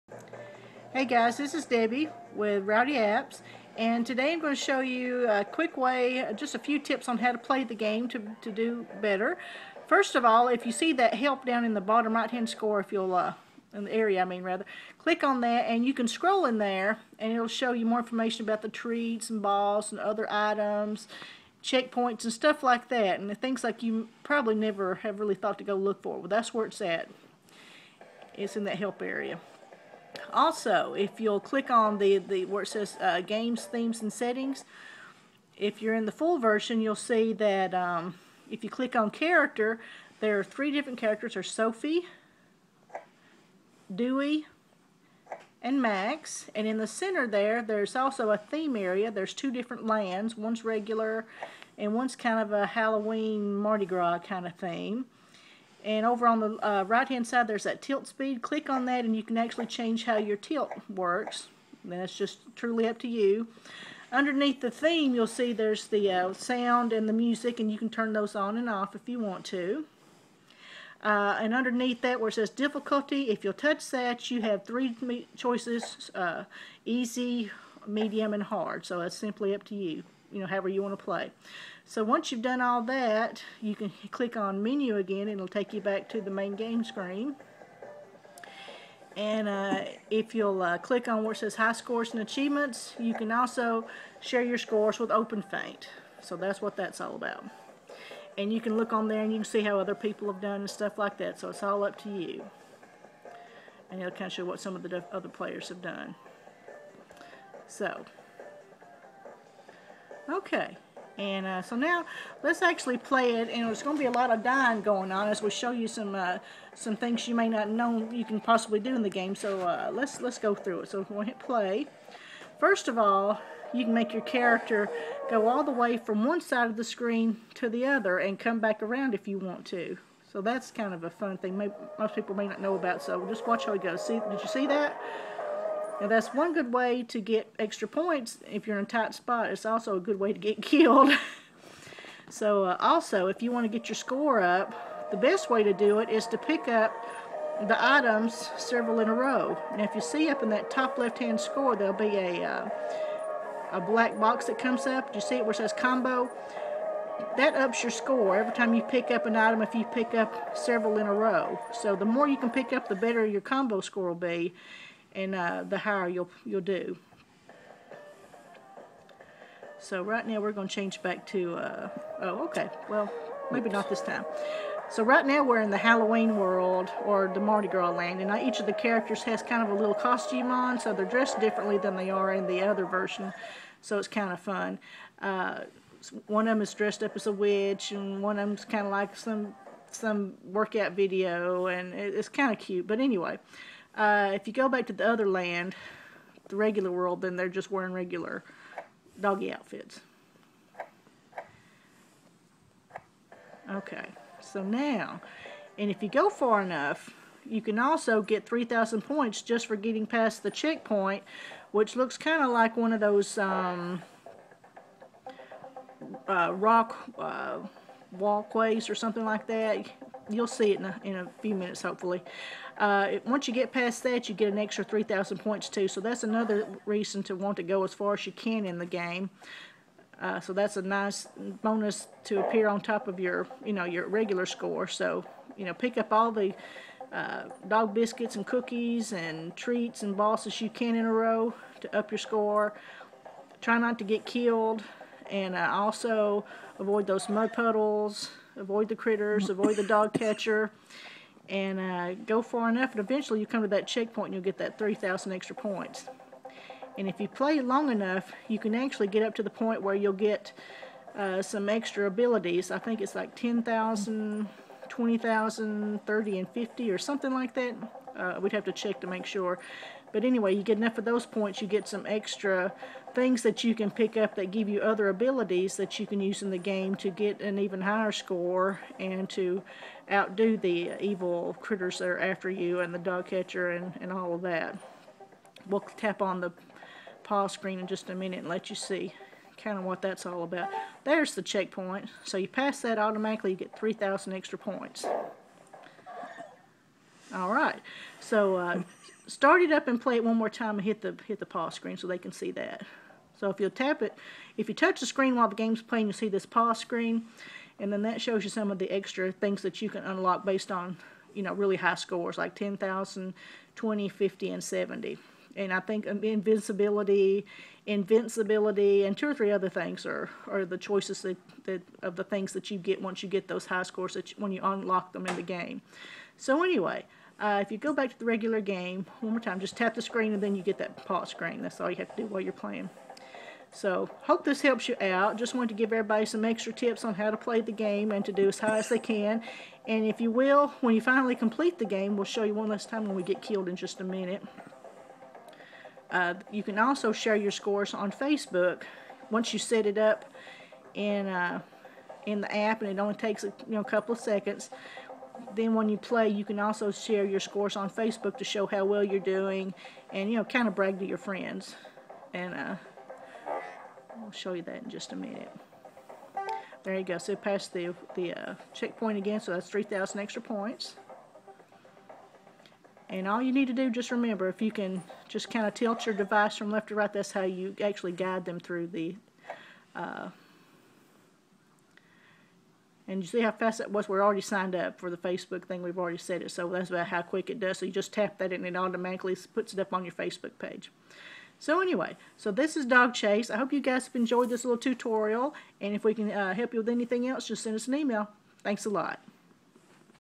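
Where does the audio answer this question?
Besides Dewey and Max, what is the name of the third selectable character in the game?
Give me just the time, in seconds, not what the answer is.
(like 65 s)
41 s.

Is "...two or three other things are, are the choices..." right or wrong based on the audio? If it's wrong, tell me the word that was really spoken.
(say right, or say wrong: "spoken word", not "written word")
right.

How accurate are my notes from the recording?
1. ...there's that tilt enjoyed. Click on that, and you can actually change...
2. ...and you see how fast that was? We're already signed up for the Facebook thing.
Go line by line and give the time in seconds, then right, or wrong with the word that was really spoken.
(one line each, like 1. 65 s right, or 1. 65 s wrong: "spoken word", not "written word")
1. 57 s wrong: "speed", not "enjoyed"
2. 383 s right.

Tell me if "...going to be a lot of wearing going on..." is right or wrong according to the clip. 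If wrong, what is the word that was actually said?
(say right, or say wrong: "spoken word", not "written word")
wrong: "dying", not "wearing".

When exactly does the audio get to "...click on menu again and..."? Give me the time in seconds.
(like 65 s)
84 s.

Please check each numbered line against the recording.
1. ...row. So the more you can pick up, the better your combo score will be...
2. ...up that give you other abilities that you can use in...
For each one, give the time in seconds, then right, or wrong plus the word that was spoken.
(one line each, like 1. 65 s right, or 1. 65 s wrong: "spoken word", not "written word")
1. 161 s right
2. 274 s right.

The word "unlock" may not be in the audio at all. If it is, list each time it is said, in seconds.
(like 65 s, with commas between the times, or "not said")
310 s, 324 s.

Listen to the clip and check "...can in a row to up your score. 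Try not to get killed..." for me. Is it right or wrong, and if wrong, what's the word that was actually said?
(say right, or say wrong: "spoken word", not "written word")
right.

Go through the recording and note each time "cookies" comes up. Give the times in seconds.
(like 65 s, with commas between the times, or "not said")
238 s.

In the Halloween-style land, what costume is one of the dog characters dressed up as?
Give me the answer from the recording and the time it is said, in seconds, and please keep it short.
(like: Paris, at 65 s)
a witch, at 187 s.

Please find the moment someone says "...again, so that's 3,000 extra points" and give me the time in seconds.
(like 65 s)
369 s.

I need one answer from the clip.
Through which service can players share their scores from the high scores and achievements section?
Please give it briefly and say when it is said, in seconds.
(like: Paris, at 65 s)
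OpenFeint, at 95 s.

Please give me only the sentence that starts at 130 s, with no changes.
So that's kind of a fun thing.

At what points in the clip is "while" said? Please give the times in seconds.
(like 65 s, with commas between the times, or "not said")
305 s, 332 s.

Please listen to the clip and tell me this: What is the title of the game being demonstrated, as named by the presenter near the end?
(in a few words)
Dog Chase.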